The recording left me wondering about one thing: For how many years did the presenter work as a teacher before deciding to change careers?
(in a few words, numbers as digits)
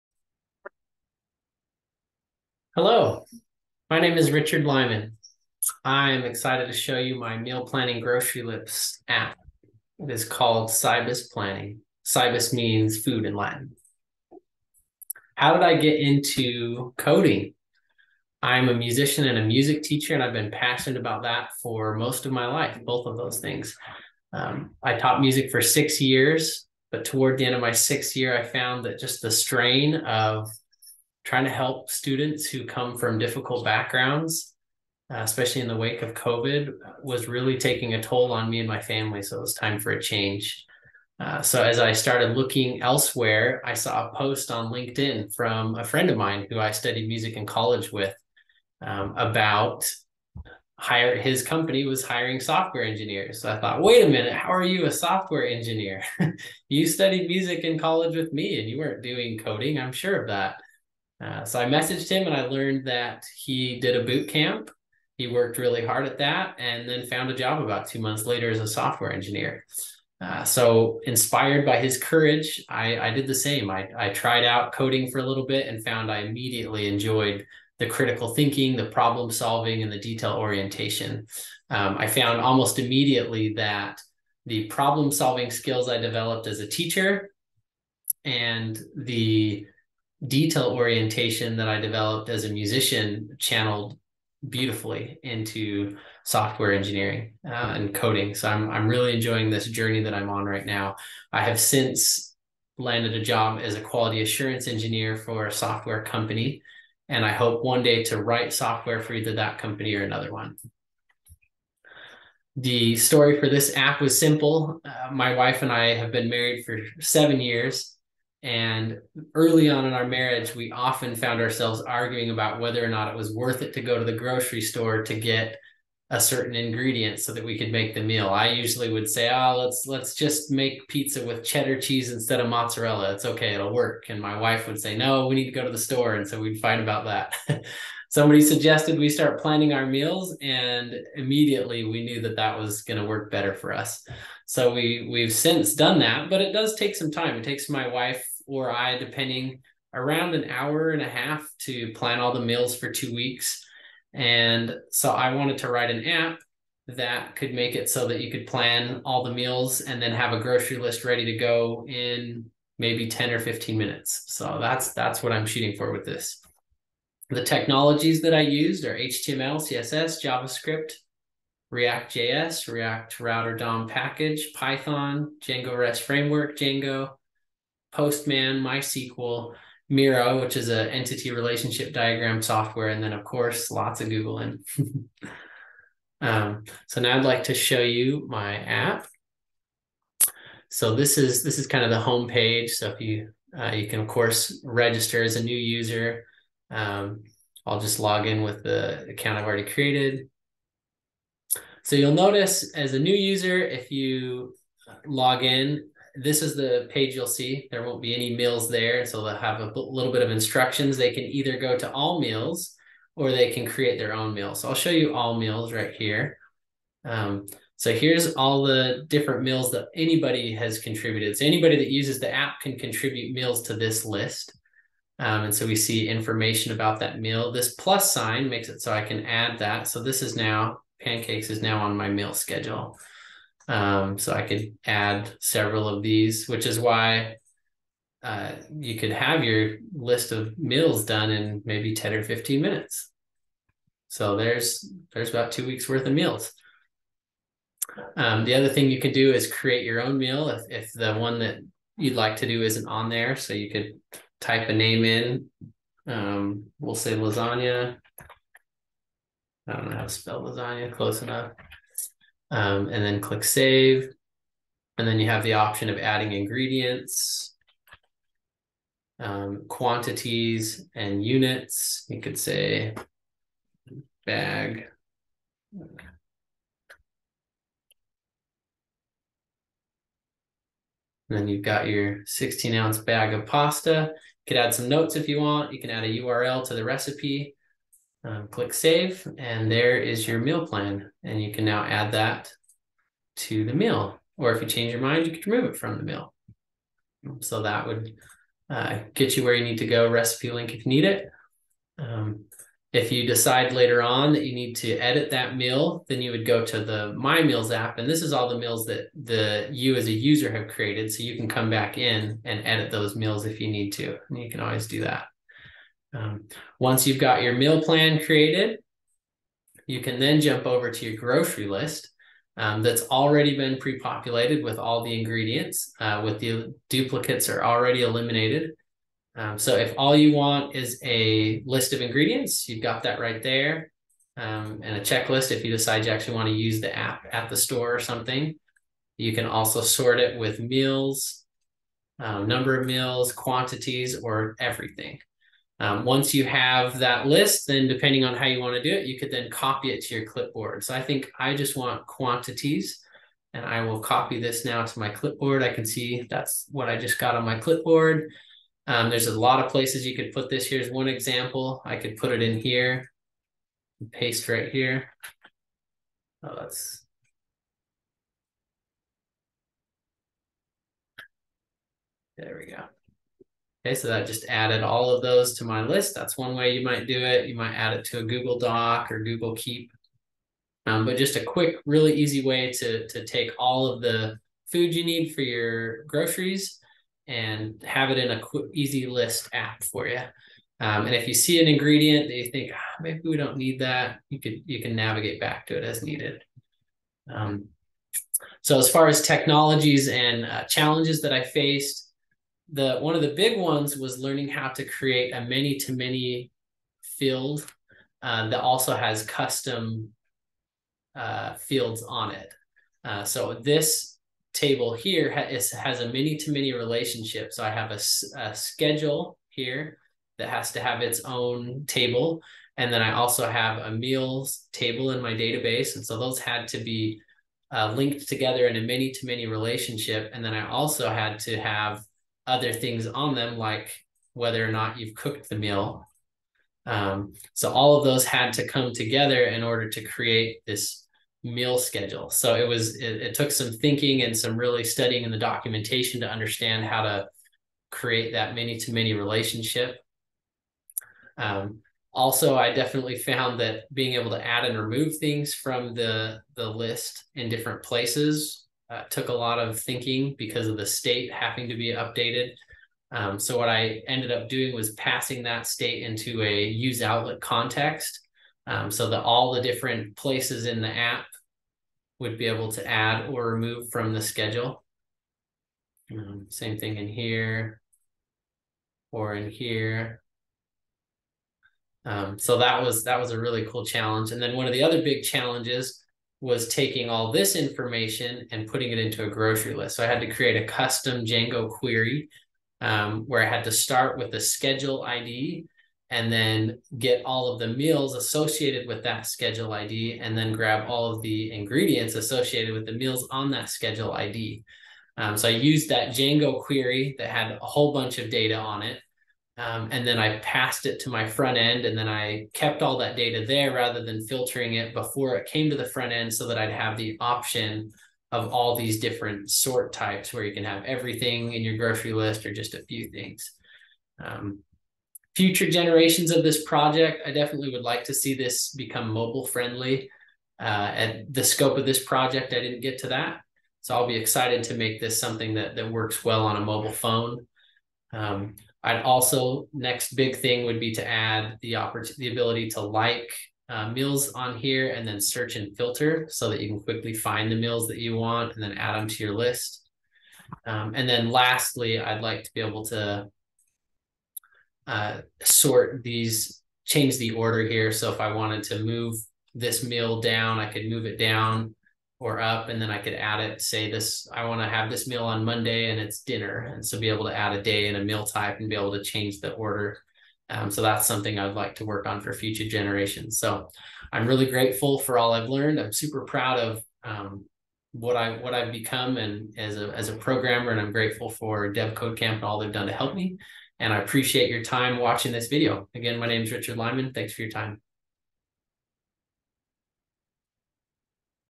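6.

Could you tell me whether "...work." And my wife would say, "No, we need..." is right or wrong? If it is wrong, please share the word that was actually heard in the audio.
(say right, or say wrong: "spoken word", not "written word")
right.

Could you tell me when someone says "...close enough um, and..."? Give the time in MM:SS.
04:20.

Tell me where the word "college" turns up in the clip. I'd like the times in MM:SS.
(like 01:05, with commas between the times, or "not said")
00:47, 00:57.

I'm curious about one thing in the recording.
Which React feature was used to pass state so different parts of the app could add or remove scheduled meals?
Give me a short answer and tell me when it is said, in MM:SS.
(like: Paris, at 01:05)
use outlet context, at 07:46.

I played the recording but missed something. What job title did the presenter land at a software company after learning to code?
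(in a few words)
quality assurance engineer.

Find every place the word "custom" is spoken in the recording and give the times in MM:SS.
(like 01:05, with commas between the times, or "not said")
06:49, 08:10.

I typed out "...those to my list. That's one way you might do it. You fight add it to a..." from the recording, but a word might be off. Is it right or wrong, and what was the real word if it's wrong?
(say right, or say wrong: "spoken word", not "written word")
wrong: "might", not "fight".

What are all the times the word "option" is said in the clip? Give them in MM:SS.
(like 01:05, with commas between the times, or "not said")
04:25, 08:37.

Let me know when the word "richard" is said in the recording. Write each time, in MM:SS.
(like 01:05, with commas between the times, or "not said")
00:04, 09:46.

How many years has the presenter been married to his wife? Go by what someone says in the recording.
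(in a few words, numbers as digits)
7.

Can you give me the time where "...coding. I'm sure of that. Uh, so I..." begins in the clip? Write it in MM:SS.
00:59.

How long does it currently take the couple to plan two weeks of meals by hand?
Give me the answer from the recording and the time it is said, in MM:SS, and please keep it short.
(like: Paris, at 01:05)
an hour and a half, at 02:30.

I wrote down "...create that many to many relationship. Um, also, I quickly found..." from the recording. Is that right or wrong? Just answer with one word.
wrong.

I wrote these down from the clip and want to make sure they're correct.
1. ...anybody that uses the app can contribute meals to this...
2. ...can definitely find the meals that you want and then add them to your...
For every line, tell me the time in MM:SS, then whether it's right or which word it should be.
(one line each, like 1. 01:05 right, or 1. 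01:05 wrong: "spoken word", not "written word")
1. 03:41 right
2. 09:06 wrong: "quickly", not "definitely".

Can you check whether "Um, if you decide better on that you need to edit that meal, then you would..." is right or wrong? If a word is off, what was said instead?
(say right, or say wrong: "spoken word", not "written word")
wrong: "later", not "better".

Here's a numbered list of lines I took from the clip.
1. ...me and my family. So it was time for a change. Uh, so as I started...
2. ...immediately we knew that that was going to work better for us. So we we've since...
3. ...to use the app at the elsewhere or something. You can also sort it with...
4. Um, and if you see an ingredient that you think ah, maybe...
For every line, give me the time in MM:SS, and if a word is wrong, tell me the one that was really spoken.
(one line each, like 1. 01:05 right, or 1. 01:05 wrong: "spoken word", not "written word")
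1. 00:38 right
2. 02:21 right
3. 05:36 wrong: "store", not "elsewhere"
4. 06:30 right.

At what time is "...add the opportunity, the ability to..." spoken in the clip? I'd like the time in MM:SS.
09:01.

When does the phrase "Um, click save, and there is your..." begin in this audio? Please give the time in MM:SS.
04:48.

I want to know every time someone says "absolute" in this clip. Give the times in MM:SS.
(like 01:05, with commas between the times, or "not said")
not said.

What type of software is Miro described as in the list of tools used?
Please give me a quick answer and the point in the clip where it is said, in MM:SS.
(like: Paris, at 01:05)
entity relationship diagram, at 03:00.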